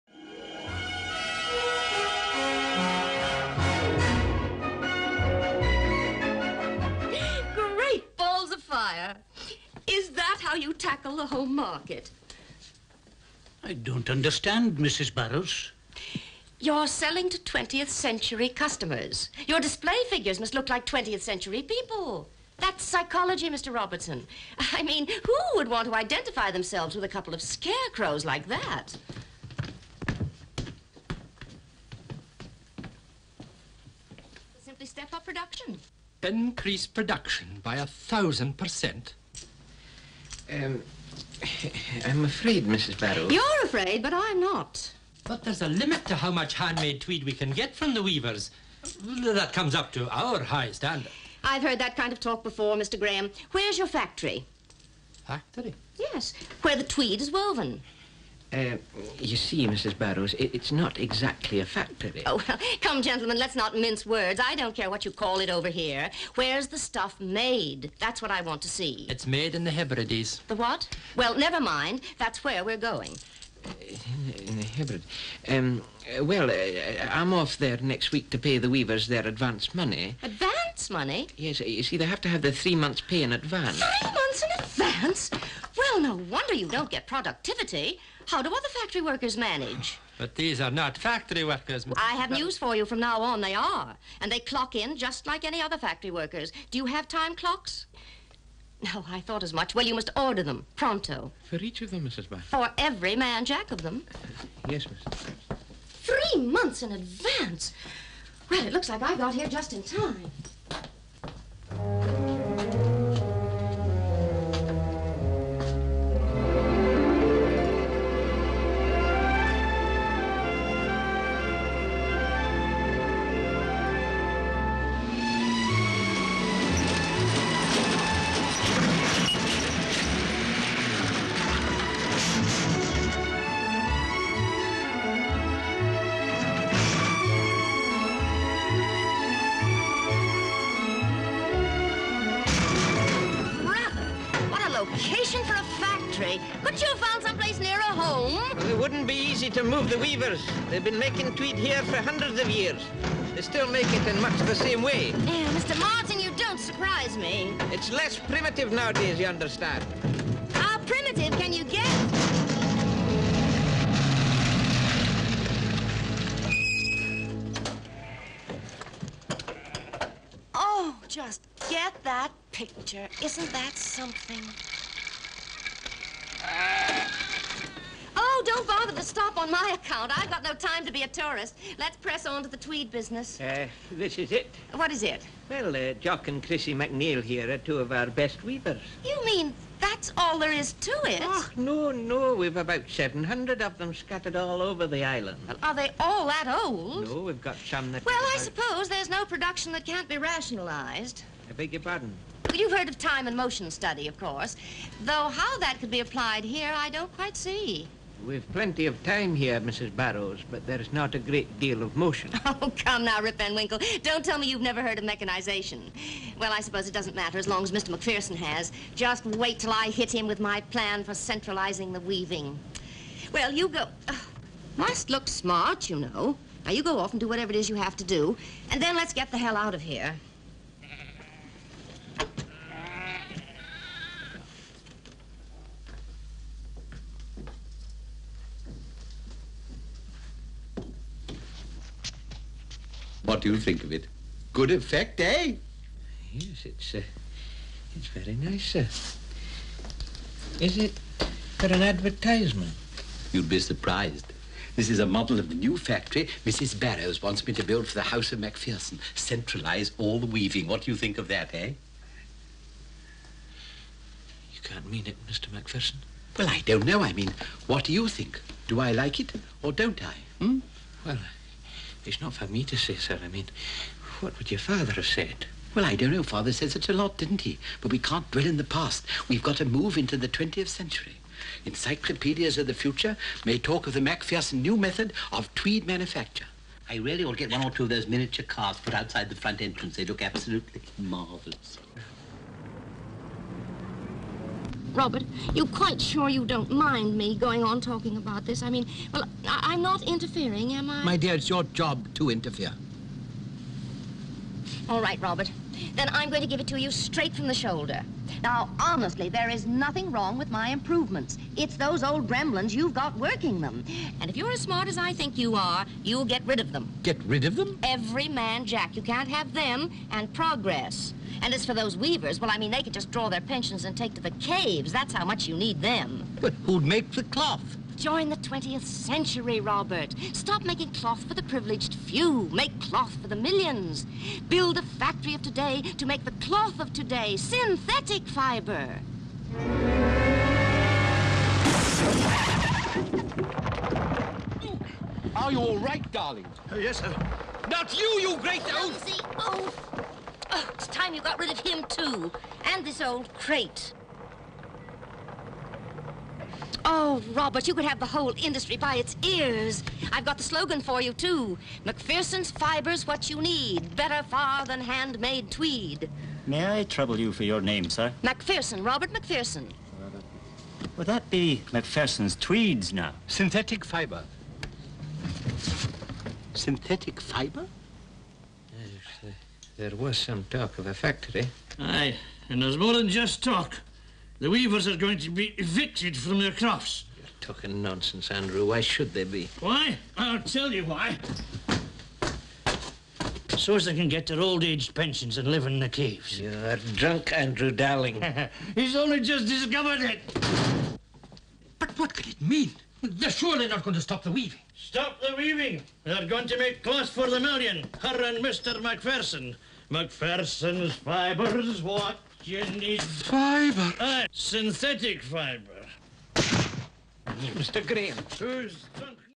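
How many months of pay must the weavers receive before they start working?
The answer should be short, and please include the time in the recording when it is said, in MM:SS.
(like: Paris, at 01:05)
3, at 01:22.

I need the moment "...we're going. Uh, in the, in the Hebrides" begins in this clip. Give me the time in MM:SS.
01:12.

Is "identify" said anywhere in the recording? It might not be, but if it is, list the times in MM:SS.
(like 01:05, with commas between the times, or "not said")
00:25.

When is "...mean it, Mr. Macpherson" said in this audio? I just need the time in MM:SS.
04:24.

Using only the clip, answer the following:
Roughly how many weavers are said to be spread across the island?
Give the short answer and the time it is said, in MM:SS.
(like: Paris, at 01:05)
700, at 03:12.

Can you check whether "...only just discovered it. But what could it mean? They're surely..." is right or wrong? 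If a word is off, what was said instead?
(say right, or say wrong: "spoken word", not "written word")
right.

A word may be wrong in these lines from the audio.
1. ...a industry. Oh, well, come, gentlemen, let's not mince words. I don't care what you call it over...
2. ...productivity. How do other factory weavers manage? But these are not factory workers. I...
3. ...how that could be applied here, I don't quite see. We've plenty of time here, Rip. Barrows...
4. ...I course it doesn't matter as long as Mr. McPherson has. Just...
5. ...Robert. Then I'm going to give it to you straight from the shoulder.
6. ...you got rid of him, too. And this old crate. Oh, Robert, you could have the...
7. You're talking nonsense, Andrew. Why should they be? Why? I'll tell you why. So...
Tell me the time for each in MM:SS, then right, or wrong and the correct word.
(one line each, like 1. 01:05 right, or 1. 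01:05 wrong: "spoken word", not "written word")
1. 01:01 wrong: "factory", not "industry"
2. 01:27 wrong: "workers", not "weavers"
3. 03:25 wrong: "Mrs", not "Rip"
4. 03:36 wrong: "suppose", not "course"
5. 05:05 right
6. 05:51 right
7. 06:27 right.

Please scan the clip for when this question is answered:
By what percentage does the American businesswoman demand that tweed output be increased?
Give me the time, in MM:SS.
00:37.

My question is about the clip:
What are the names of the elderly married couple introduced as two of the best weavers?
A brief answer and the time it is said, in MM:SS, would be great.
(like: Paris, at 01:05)
Jock and Chrissy McNeil, at 03:05.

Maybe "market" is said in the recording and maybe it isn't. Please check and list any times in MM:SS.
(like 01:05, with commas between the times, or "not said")
00:11.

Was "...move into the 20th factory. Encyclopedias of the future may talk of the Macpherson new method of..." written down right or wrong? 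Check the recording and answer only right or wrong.
wrong.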